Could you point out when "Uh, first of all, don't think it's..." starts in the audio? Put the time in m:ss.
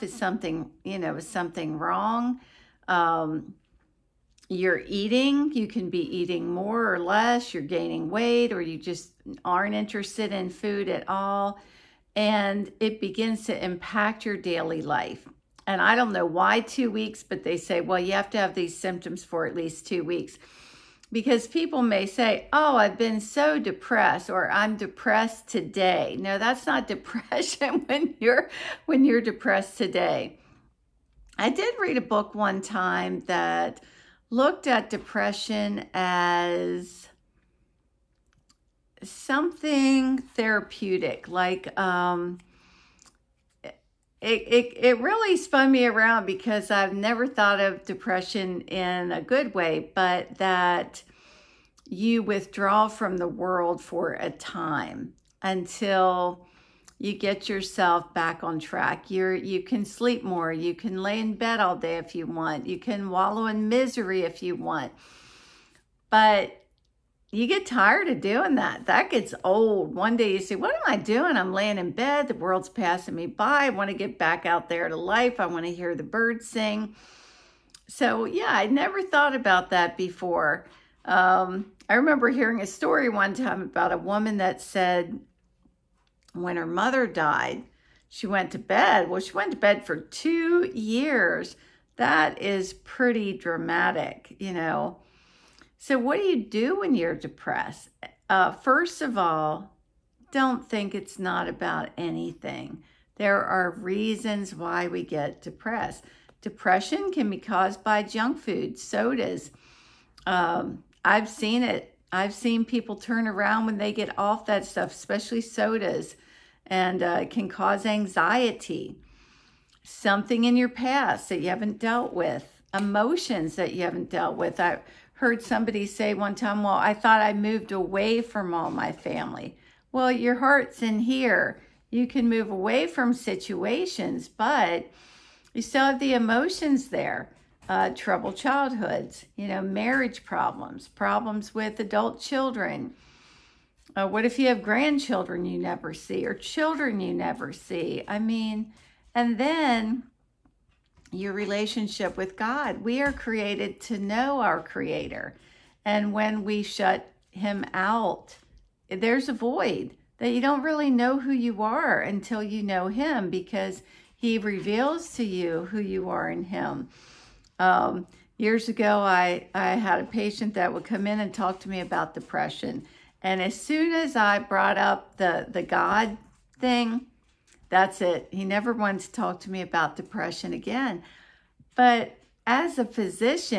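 1:38.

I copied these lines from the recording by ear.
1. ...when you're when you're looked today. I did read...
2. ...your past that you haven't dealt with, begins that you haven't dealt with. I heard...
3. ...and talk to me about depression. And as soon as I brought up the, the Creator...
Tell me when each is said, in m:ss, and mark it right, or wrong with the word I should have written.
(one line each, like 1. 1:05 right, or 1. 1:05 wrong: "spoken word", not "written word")
1. 0:27 wrong: "depressed", not "looked"
2. 2:00 wrong: "emotions", not "begins"
3. 2:51 wrong: "God", not "Creator".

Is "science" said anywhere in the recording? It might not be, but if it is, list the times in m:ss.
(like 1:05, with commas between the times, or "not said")
not said.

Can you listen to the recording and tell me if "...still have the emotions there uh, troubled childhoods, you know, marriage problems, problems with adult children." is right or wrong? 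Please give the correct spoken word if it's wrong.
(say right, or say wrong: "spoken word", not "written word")
right.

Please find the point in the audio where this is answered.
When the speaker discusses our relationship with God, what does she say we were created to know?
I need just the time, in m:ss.
2:34.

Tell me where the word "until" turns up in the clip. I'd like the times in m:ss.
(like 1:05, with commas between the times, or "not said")
0:55, 2:42.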